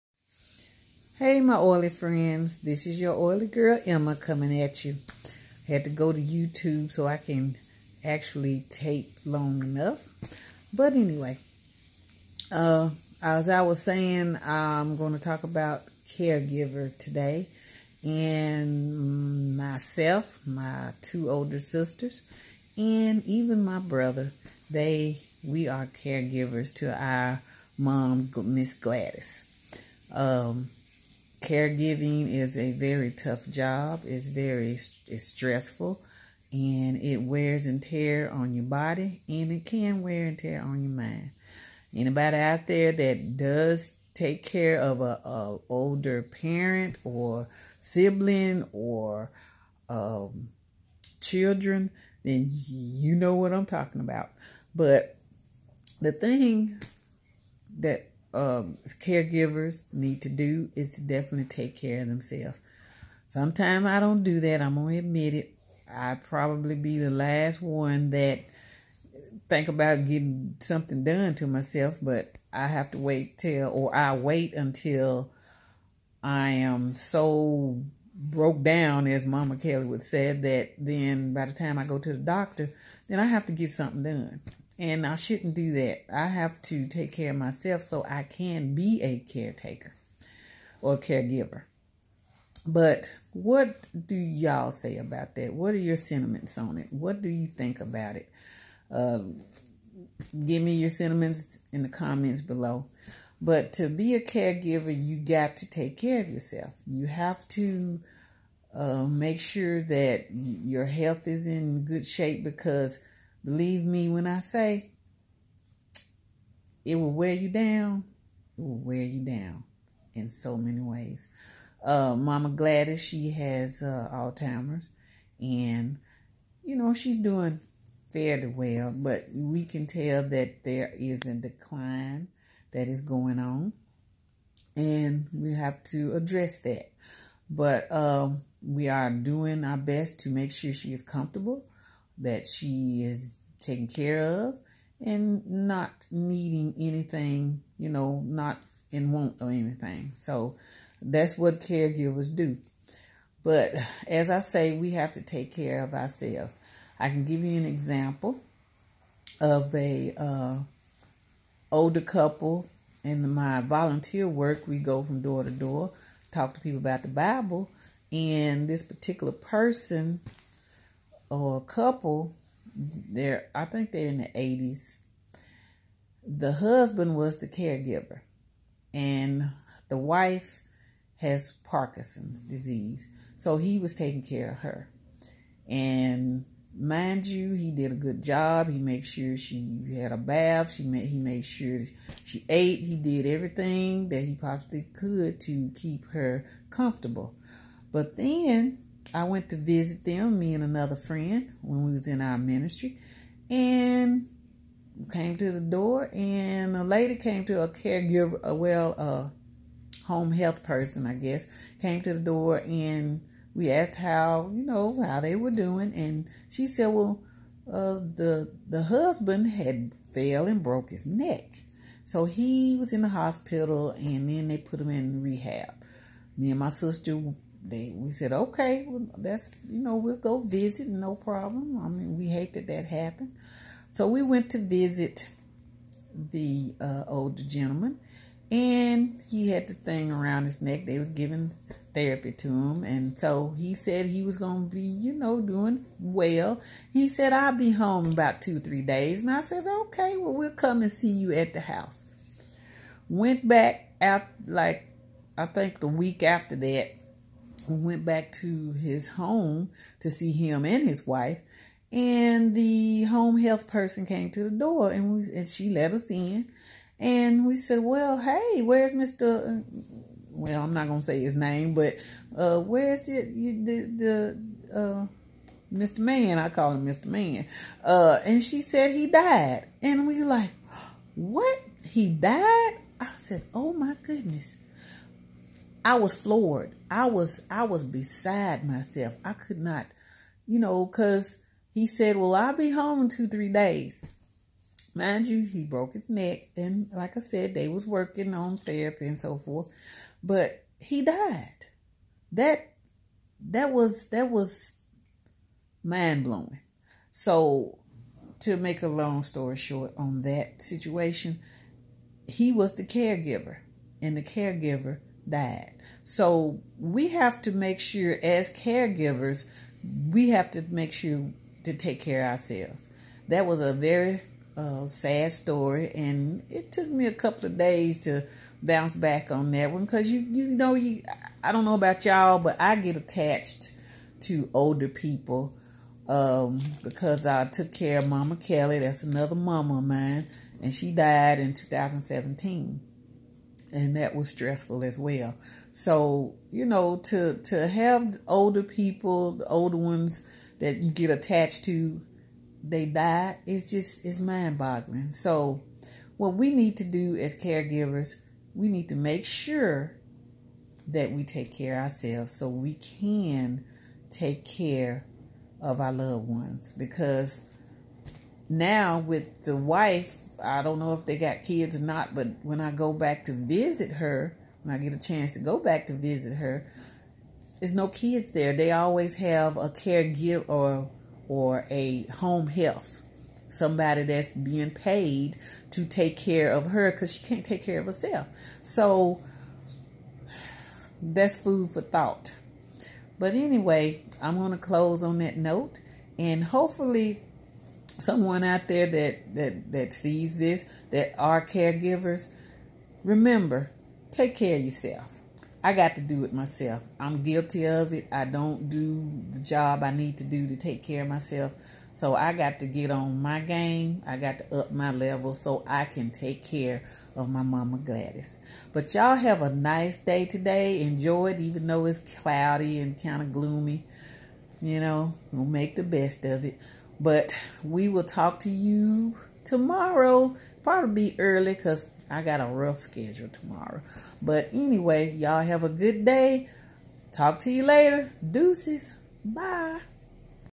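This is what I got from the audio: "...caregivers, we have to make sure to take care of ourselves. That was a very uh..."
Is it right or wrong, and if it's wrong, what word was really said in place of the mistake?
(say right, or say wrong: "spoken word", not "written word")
right.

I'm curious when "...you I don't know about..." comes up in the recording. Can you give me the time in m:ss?
5:30.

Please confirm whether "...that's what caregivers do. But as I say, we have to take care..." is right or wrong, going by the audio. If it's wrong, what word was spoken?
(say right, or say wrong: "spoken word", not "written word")
right.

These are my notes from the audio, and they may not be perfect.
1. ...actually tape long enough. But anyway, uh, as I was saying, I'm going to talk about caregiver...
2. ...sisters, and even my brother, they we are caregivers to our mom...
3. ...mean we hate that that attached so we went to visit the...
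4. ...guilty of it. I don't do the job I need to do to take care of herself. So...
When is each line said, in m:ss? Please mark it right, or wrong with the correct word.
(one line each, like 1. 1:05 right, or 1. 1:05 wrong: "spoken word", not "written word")
1. 0:08 right
2. 0:21 right
3. 3:51 wrong: "happened", not "attached"
4. 6:47 wrong: "myself", not "herself".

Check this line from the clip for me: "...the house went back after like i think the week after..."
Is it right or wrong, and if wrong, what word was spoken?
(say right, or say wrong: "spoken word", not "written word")
right.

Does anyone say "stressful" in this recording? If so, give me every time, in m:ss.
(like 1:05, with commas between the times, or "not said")
0:35, 5:44.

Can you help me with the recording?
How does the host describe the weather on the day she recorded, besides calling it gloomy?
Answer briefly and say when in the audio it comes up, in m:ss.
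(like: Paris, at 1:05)
Cloudy, at 7:02.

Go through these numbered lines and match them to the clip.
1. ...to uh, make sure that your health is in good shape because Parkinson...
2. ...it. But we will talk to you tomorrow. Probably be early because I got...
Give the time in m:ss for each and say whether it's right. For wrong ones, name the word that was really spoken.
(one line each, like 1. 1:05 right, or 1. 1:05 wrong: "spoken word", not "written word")
1. 1:47 wrong: "Believe", not "Parkinson"
2. 7:06 right.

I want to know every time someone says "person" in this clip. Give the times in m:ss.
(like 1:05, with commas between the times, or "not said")
2:49, 3:30, 4:23.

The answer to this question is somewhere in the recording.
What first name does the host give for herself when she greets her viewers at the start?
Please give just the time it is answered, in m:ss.
0:03.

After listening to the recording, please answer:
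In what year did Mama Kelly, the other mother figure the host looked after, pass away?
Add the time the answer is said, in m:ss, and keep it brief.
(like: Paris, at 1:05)
2017, at 5:41.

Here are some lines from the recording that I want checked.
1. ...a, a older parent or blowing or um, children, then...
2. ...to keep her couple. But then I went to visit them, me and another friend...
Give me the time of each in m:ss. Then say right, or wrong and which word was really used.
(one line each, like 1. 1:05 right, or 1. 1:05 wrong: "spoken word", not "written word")
1. 0:45 wrong: "sibling", not "blowing"
2. 3:15 wrong: "comfortable", not "couple".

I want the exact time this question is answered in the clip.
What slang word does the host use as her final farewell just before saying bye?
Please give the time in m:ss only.
7:18.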